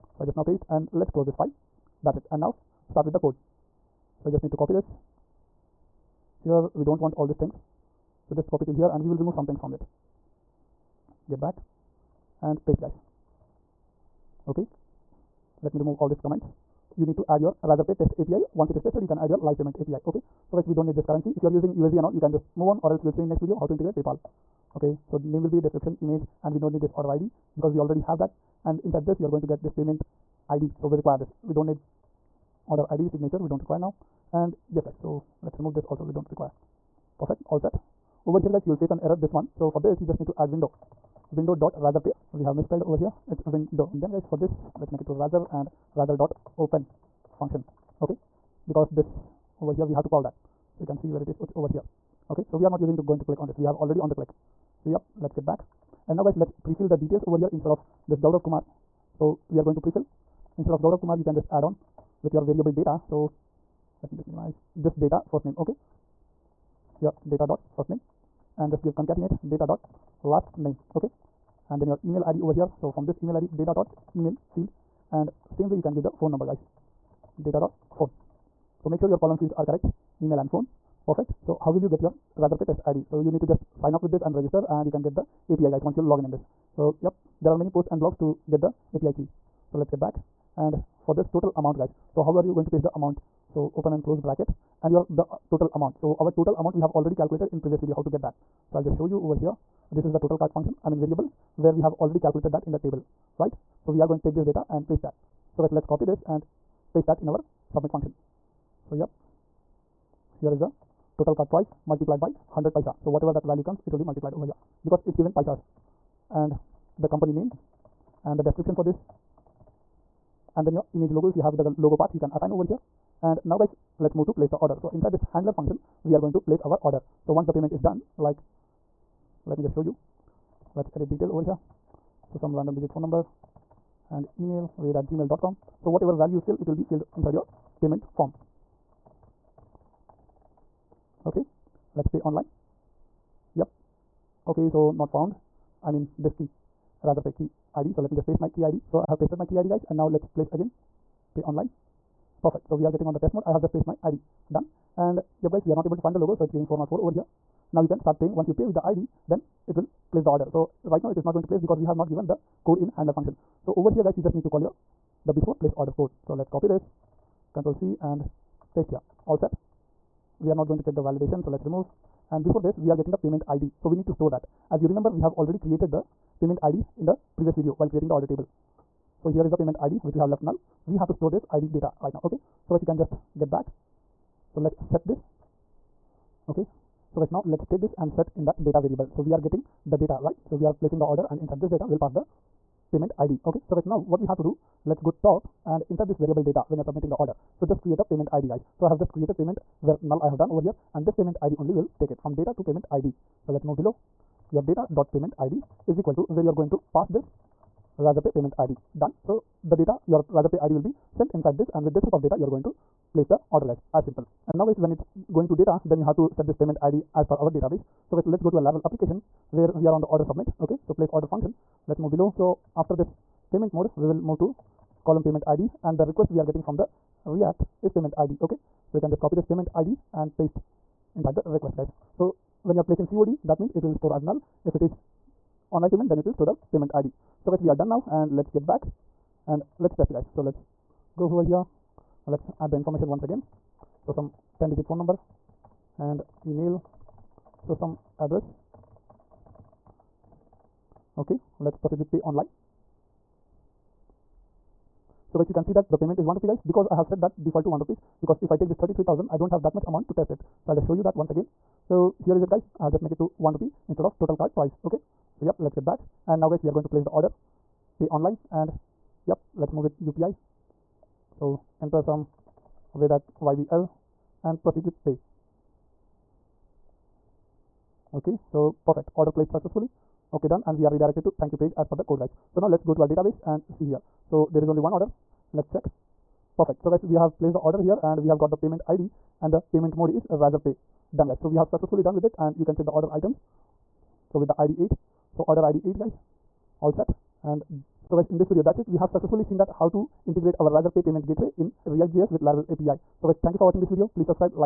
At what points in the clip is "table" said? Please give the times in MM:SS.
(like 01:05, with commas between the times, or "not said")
01:42, 02:58.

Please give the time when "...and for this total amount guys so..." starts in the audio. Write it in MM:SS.
01:30.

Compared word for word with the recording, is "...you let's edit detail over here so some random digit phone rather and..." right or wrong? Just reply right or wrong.
wrong.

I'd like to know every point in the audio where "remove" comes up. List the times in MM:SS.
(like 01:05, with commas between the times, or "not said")
00:09, 00:15, 00:35, 02:51.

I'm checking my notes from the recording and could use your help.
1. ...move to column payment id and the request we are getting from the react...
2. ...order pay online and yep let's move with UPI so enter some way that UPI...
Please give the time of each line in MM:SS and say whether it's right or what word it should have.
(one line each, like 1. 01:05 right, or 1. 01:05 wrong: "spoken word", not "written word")
1. 03:44 right
2. 04:27 wrong: "YBL", not "UPI".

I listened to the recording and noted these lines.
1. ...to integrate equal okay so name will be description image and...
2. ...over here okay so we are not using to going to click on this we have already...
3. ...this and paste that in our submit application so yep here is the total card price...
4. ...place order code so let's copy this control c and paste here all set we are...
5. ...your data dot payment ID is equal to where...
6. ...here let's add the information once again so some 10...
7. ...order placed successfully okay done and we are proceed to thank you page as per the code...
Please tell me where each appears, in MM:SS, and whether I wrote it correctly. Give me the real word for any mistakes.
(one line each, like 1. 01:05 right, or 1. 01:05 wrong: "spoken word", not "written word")
1. 00:23 wrong: "paypal", not "equal"
2. 00:51 right
3. 01:46 wrong: "function", not "application"
4. 02:45 right
5. 03:24 right
6. 04:01 right
7. 04:39 wrong: "redirected", not "proceed".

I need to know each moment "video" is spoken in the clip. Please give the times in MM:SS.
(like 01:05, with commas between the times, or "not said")
00:23, 01:37, 02:57, 04:58, 05:03.